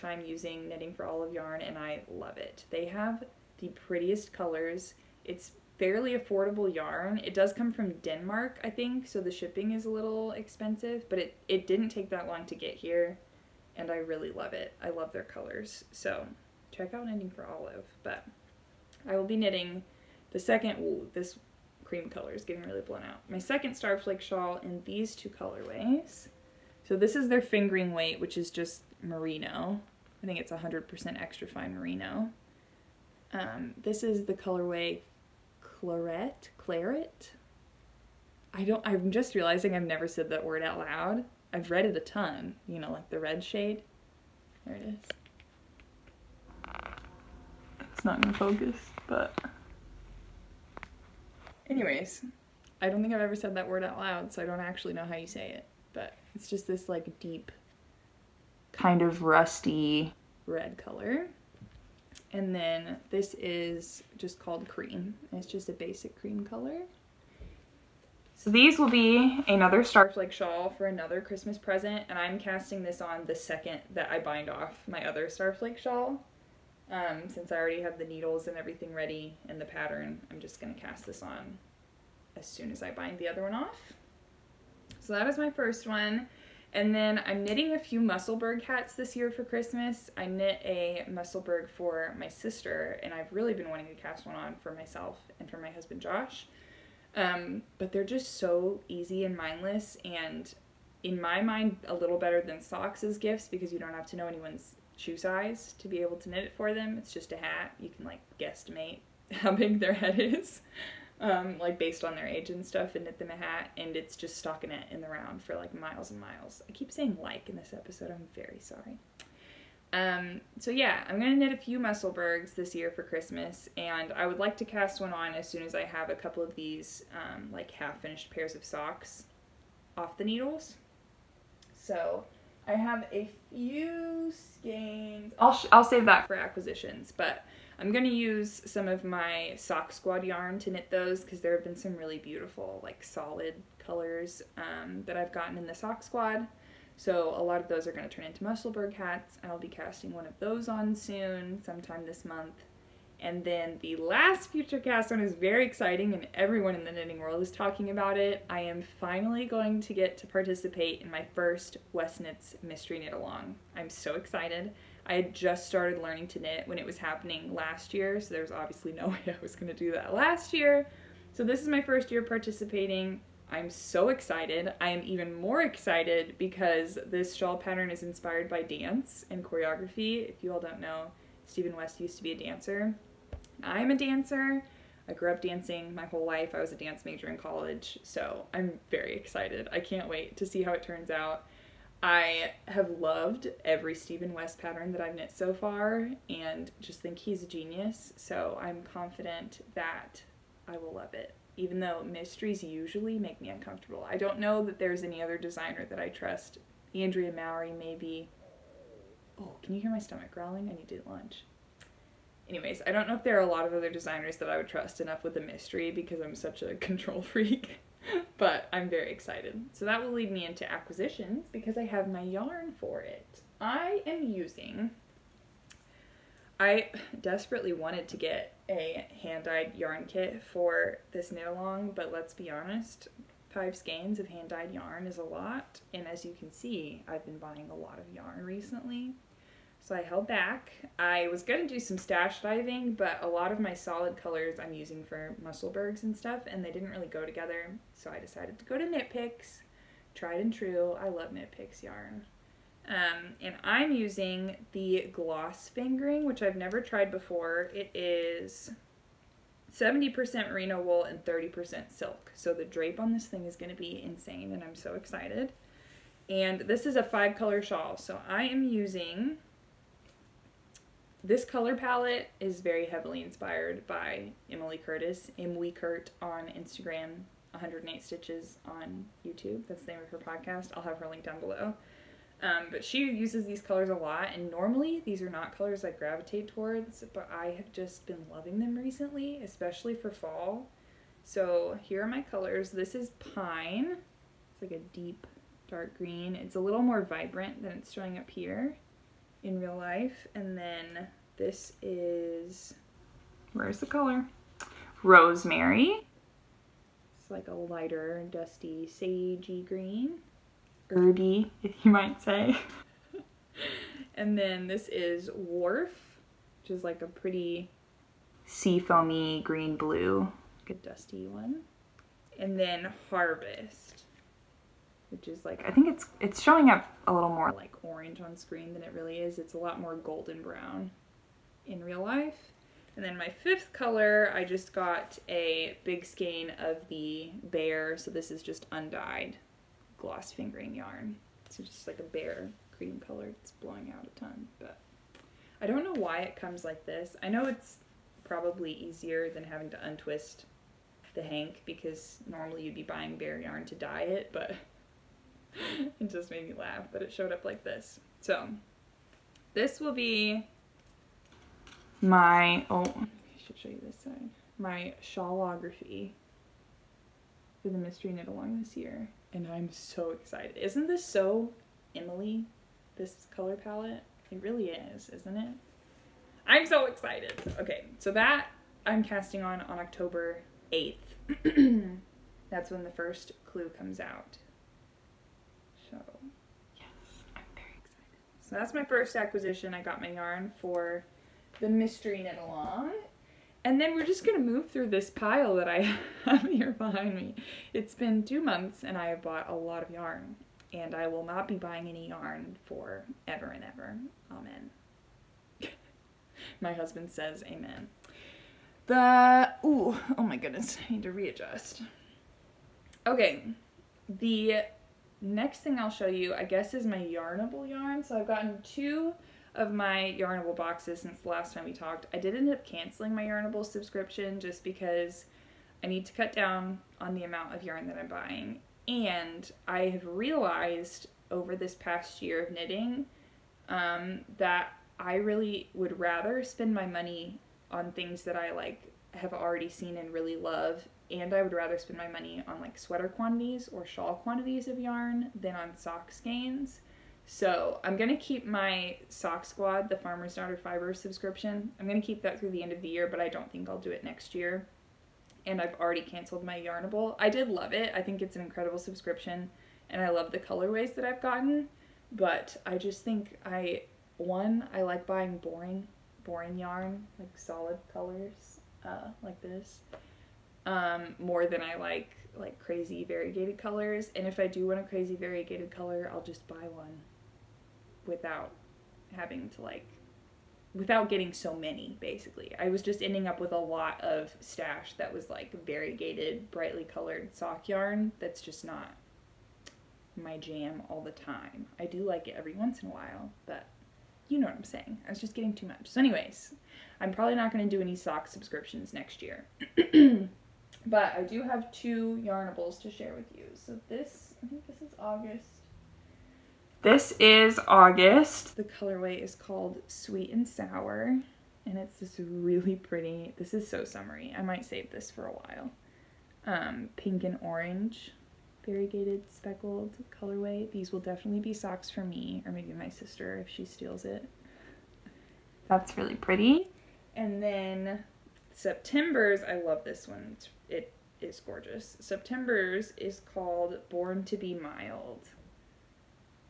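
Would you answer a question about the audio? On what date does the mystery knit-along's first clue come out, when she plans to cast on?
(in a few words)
October 8.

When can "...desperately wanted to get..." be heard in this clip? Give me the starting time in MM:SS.
03:47.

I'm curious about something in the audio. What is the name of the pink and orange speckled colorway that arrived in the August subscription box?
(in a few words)
Sweet and Sour.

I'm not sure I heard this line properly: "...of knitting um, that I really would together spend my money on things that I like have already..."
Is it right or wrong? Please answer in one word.
wrong.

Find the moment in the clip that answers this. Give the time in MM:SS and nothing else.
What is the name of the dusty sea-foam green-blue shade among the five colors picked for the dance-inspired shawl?
05:15.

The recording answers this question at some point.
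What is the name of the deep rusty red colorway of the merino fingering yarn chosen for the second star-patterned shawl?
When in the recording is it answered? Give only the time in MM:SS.
00:33.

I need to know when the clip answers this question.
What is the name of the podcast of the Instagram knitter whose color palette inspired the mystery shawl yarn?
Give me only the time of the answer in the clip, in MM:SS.
04:37.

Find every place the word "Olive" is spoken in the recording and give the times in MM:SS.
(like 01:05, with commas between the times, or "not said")
00:01, 00:17.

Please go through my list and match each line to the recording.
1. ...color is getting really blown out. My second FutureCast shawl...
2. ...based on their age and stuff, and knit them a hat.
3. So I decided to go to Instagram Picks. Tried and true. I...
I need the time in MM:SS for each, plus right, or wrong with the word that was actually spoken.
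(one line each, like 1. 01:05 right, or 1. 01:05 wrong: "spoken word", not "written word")
1. 00:22 wrong: "Starflake", not "FutureCast"
2. 01:51 right
3. 04:07 wrong: "Knit", not "Instagram".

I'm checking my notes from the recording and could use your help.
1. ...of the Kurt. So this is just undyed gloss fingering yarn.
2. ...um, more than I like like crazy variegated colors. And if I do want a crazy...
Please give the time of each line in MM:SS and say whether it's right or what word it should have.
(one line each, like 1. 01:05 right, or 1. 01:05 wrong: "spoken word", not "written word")
1. 05:36 wrong: "Bare", not "Kurt"
2. 07:50 right.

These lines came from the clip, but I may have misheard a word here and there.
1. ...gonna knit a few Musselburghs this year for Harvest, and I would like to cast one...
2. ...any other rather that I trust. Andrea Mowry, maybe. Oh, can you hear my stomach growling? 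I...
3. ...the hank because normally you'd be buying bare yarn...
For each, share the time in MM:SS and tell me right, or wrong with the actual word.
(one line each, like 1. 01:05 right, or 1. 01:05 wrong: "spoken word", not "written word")
1. 02:01 wrong: "Christmas", not "Harvest"
2. 03:25 wrong: "designer", not "rather"
3. 05:51 right.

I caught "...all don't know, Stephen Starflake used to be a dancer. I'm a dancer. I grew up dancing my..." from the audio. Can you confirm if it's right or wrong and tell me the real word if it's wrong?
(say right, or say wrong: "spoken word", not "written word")
wrong: "West", not "Starflake".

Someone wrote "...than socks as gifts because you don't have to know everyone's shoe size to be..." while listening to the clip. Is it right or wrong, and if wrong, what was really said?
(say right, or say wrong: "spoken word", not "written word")
wrong: "anyone", not "everyone".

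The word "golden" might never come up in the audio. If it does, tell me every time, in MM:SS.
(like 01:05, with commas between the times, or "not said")
05:29.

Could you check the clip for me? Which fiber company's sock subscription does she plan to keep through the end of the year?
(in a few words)
Farmer's Daughter Fiber.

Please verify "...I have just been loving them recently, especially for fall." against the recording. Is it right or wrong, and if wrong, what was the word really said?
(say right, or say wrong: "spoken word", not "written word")
right.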